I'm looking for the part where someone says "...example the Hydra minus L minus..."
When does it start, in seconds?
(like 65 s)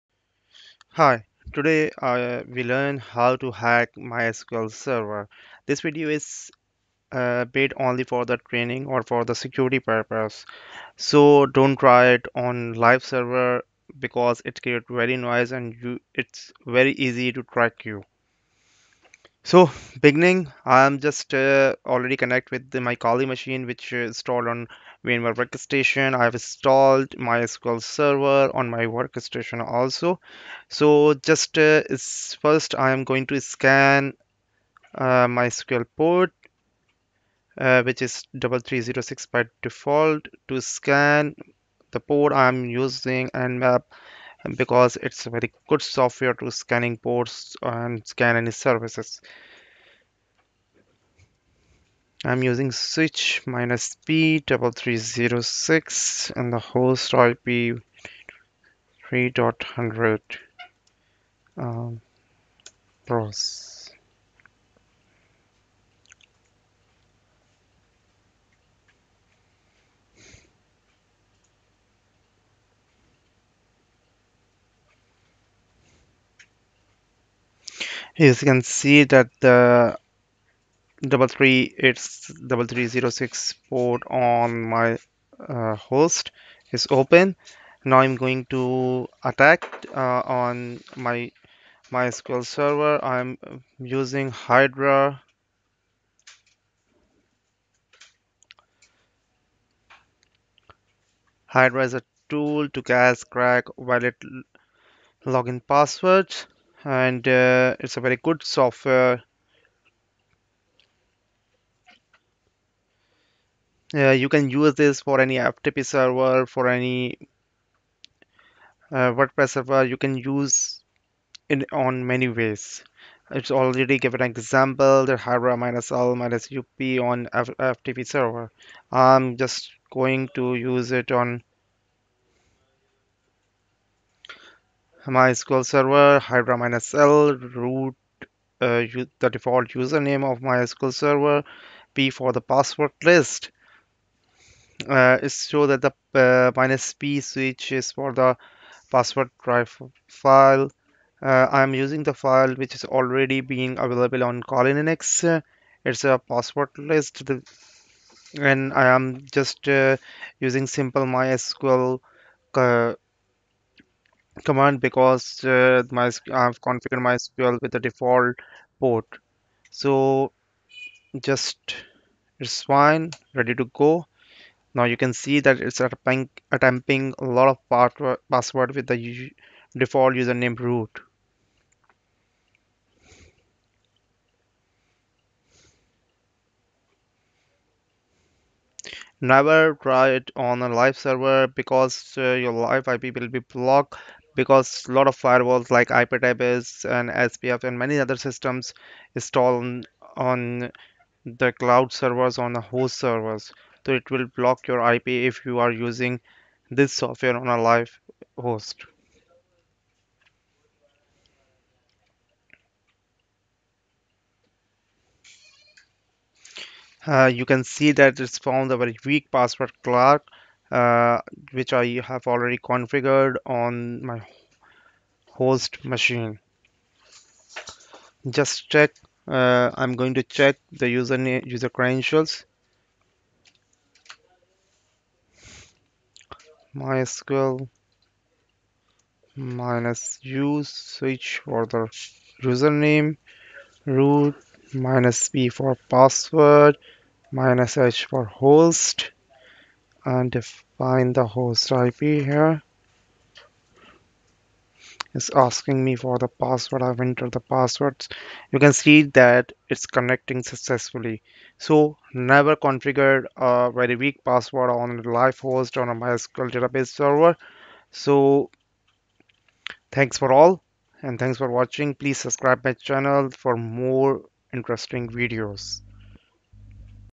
124 s.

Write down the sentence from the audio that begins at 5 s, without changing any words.
This video is uh, made only for the training or for the security purpose.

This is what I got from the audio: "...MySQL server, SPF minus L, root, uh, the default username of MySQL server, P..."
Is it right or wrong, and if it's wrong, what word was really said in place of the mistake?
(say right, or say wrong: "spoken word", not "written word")
wrong: "Hydra", not "SPF".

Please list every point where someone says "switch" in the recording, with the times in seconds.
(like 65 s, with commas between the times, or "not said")
52 s, 147 s, 240 s.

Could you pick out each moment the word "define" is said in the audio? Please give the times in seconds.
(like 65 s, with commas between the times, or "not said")
250 s.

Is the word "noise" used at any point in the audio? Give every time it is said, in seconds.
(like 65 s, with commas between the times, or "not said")
15 s.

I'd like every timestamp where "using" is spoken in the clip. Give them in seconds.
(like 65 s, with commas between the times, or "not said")
42 s, 52 s, 93 s, 151 s, 160 s, 205 s.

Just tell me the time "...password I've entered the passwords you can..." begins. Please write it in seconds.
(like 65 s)
256 s.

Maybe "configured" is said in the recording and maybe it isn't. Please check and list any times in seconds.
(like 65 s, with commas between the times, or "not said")
166 s, 222 s, 262 s.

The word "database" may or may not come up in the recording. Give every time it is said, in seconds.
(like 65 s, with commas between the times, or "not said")
266 s.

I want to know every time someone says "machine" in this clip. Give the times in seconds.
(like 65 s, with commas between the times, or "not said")
23 s, 225 s.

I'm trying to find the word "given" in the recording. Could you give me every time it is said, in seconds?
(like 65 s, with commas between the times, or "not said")
123 s.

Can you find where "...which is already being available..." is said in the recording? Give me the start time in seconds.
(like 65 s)
152 s.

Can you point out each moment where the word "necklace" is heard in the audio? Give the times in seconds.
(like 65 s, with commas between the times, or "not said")
not said.